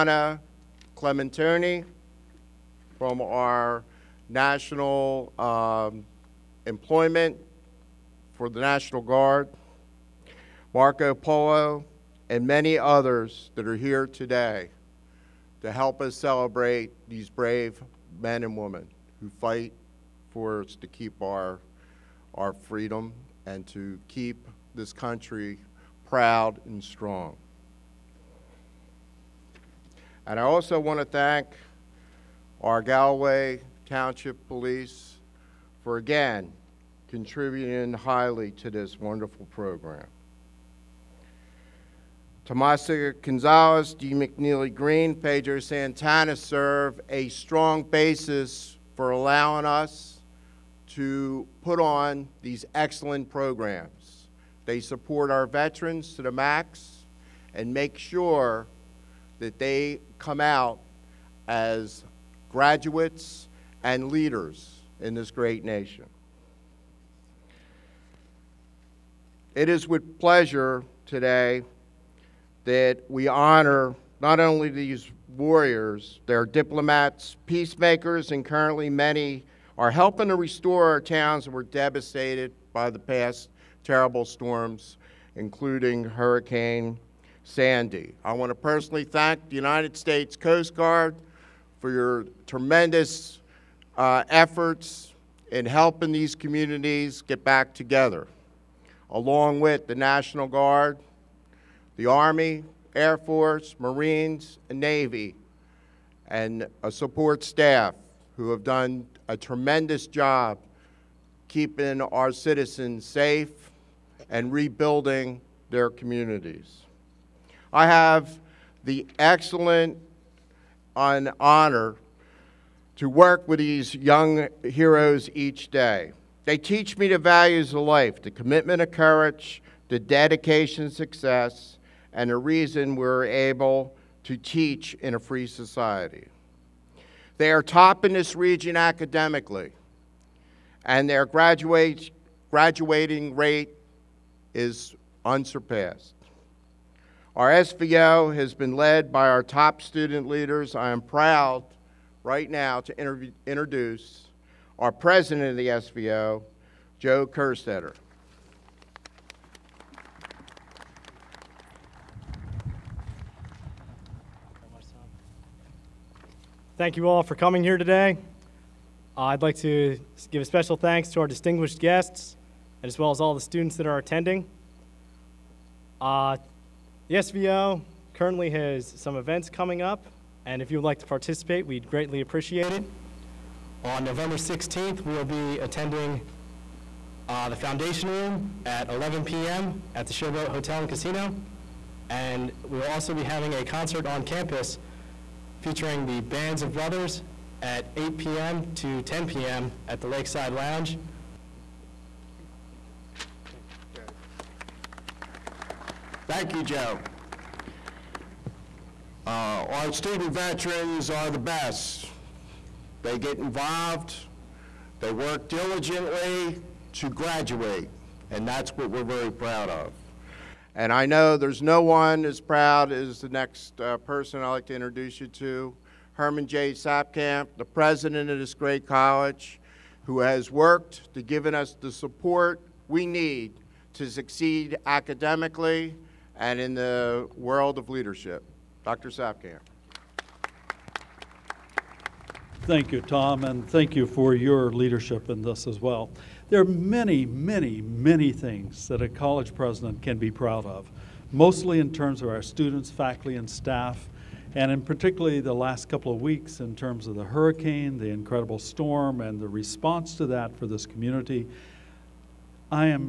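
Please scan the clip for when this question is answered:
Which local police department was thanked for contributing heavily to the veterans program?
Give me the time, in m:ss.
0:32.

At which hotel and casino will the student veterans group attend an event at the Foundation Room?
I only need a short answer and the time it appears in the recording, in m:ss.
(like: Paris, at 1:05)
Showboat Hotel and Casino, at 3:10.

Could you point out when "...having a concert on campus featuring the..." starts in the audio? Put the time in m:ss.
3:13.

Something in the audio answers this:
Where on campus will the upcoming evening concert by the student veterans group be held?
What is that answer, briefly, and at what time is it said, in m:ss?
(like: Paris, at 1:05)
Lakeside Lounge, at 3:20.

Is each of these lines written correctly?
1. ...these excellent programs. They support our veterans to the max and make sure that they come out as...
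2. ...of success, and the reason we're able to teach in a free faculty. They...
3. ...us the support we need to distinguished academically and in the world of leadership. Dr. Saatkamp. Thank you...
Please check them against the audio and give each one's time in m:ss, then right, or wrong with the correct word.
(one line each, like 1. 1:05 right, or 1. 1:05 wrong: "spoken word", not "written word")
1. 0:52 right
2. 2:10 wrong: "society", not "faculty"
3. 3:51 wrong: "succeed", not "distinguished".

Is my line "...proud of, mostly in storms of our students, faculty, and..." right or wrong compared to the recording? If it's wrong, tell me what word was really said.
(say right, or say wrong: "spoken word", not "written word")
wrong: "terms", not "storms".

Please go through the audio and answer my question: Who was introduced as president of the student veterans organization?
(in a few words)
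Joe Kerstetter.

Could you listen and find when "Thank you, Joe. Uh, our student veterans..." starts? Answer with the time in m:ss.
3:26.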